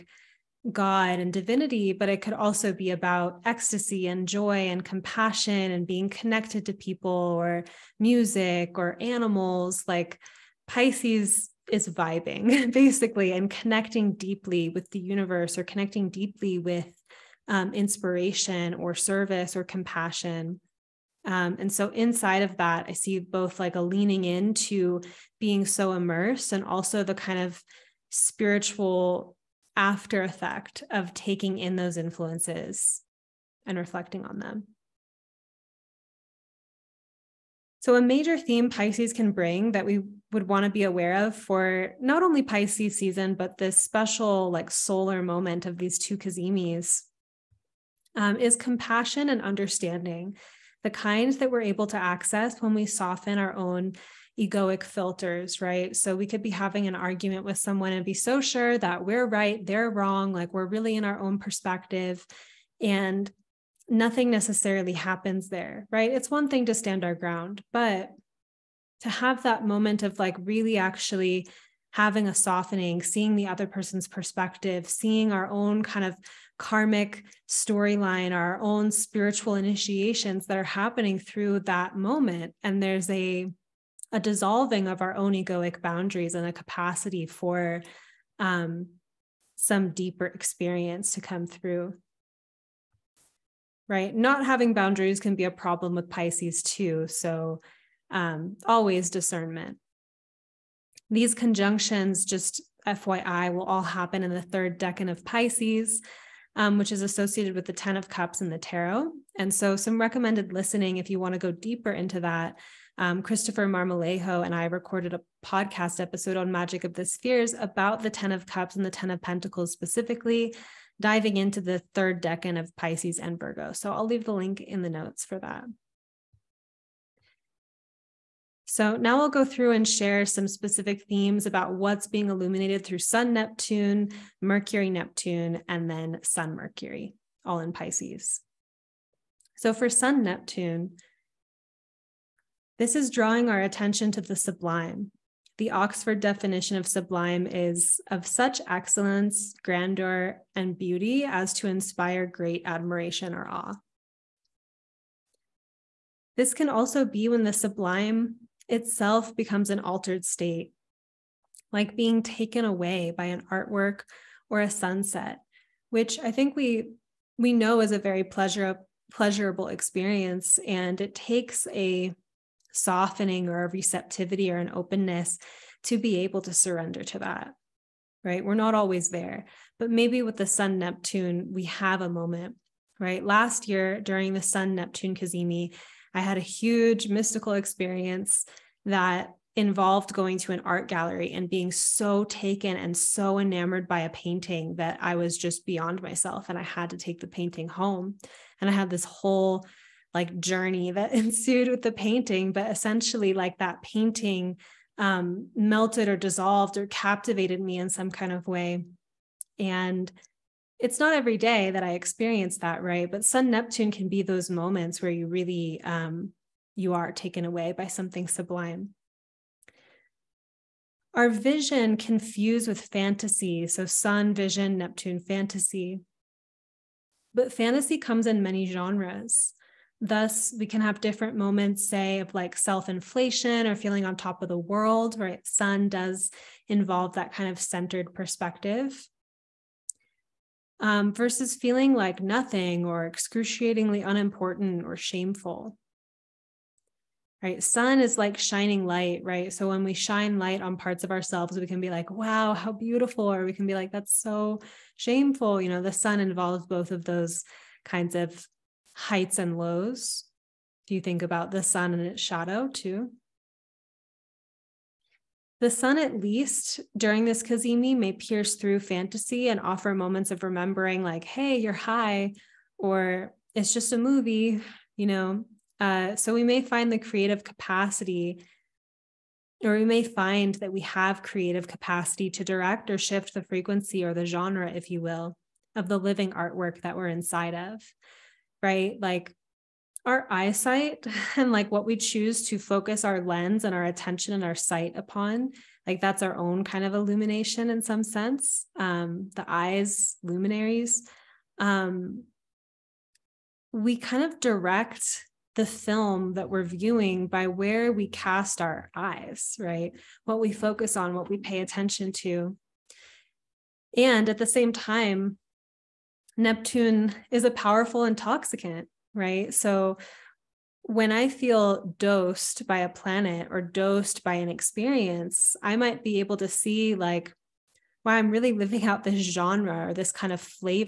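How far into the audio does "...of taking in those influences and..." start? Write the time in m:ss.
0:30.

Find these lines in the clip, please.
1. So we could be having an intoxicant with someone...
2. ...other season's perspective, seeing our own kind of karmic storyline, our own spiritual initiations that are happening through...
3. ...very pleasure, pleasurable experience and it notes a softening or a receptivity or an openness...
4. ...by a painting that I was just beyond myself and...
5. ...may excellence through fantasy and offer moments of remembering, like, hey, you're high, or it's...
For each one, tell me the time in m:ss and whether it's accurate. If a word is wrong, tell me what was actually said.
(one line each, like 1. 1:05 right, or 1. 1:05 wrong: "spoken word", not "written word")
1. 0:55 wrong: "argument", not "intoxicant"
2. 1:13 wrong: "person", not "season"
3. 2:47 wrong: "takes", not "notes"
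4. 3:13 right
5. 4:27 wrong: "pierce", not "excellence".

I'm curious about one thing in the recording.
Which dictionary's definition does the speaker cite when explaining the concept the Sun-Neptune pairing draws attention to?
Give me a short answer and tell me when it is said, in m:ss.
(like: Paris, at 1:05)
Oxford, at 2:25.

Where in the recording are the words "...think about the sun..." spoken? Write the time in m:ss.
4:21.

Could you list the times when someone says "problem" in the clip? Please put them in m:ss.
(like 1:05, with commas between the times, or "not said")
1:35.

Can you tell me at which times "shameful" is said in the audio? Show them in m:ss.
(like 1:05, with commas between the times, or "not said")
4:04, 4:14.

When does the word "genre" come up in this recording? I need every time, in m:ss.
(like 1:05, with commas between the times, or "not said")
3:48, 4:44, 5:29.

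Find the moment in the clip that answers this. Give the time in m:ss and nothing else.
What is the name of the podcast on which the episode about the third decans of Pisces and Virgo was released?
1:56.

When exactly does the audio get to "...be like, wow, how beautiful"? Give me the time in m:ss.
4:11.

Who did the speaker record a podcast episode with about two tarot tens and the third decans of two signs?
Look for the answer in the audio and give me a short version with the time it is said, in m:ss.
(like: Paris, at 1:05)
Christopher Marmolejo, at 1:53.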